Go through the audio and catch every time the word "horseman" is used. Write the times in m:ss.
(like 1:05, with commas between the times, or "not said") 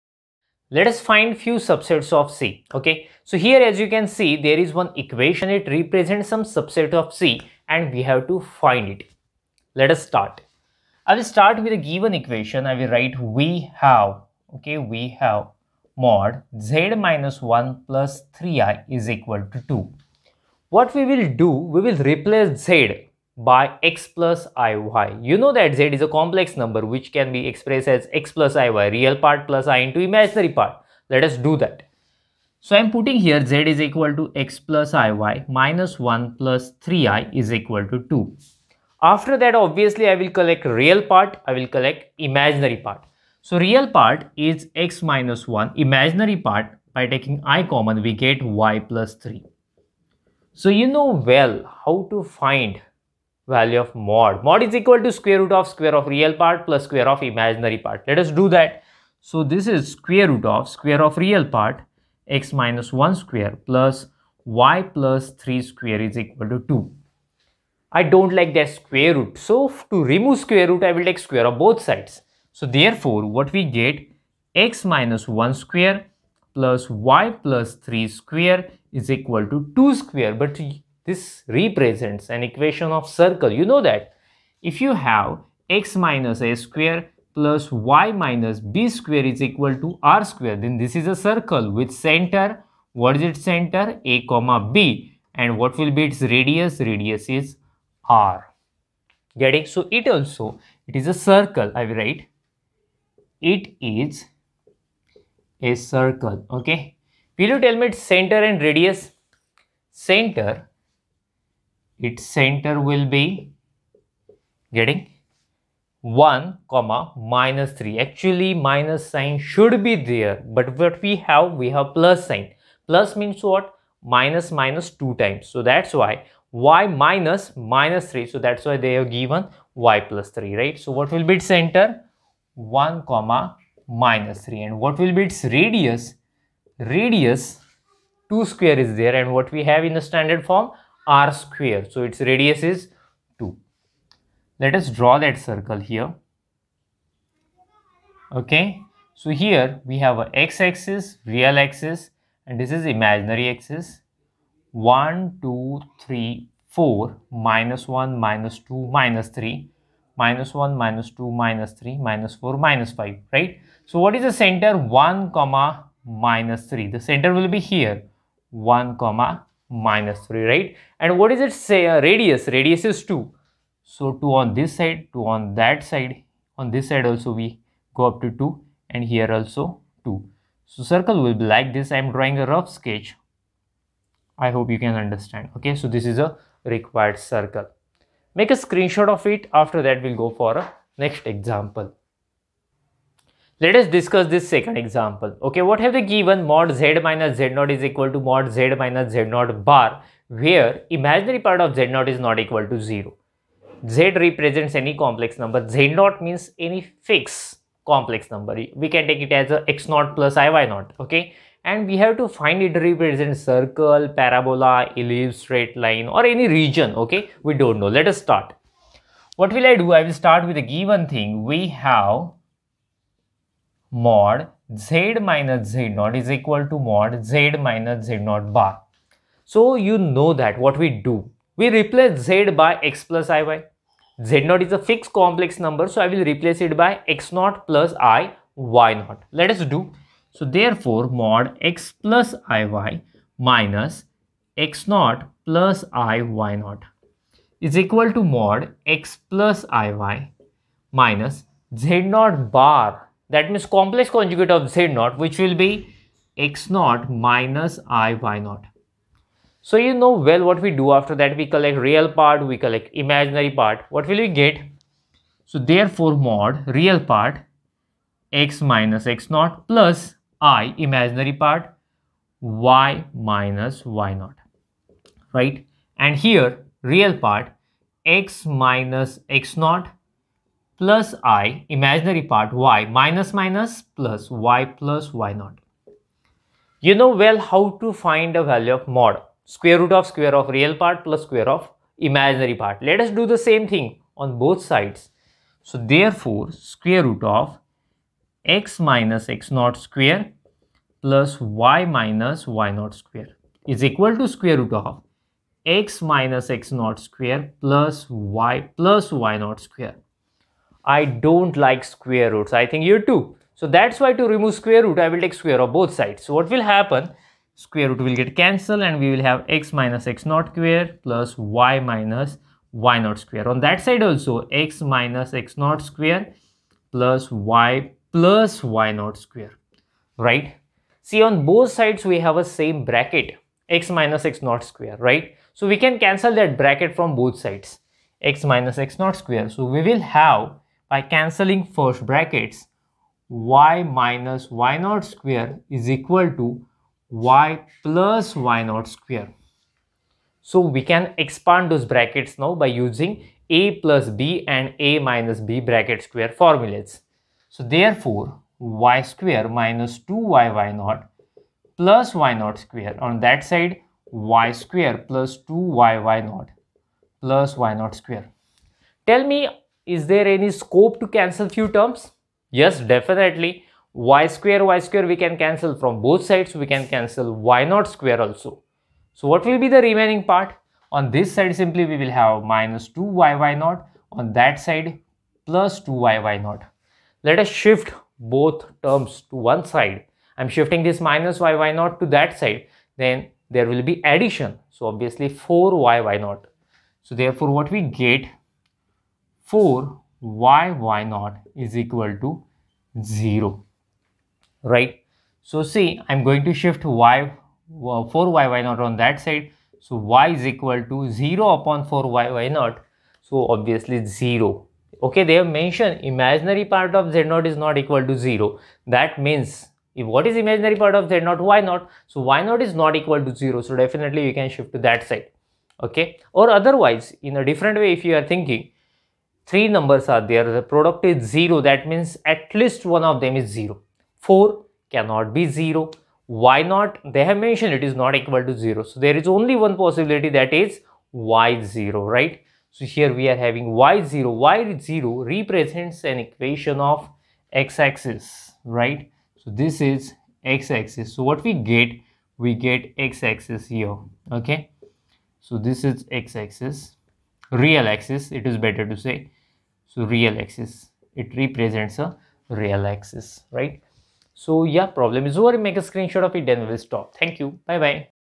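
not said.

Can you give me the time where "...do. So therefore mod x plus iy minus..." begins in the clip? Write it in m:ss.
3:59.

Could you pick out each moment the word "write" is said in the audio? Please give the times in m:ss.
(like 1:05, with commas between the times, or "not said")
0:12, 1:41.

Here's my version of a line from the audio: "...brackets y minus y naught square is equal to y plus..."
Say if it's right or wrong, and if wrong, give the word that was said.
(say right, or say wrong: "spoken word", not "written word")
right.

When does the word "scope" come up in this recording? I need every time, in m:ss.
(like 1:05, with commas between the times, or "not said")
6:10.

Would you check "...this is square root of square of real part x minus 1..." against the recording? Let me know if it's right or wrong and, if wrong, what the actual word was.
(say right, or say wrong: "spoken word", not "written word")
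right.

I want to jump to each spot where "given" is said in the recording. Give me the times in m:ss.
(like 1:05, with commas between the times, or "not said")
0:11, 2:09, 3:16, 3:40.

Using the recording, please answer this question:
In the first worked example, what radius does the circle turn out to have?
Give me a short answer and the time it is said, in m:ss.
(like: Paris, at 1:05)
2, at 2:22.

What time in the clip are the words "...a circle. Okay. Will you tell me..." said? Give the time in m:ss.
1:45.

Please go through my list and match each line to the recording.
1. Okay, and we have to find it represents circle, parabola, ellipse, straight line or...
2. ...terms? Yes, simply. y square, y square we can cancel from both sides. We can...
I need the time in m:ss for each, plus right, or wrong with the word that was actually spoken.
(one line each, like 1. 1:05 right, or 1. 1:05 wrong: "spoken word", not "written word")
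1. 3:30 right
2. 6:11 wrong: "definitely", not "simply".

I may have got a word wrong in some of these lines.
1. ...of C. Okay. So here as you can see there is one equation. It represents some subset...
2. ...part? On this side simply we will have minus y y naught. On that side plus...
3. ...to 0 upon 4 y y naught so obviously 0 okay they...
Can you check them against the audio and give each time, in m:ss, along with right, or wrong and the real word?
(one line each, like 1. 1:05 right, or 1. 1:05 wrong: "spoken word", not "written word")
1. 0:02 right
2. 6:20 right
3. 6:50 right.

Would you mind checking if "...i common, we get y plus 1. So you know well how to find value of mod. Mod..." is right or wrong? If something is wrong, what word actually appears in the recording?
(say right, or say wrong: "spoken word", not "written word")
wrong: "3", not "1".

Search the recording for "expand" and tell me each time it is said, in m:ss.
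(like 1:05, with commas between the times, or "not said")
5:51.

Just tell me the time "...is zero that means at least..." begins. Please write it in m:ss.
7:11.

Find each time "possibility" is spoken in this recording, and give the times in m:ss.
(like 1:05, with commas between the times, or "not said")
7:19.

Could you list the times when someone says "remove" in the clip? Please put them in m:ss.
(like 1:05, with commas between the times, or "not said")
1:10, 5:14.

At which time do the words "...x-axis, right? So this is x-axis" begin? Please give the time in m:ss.
7:27.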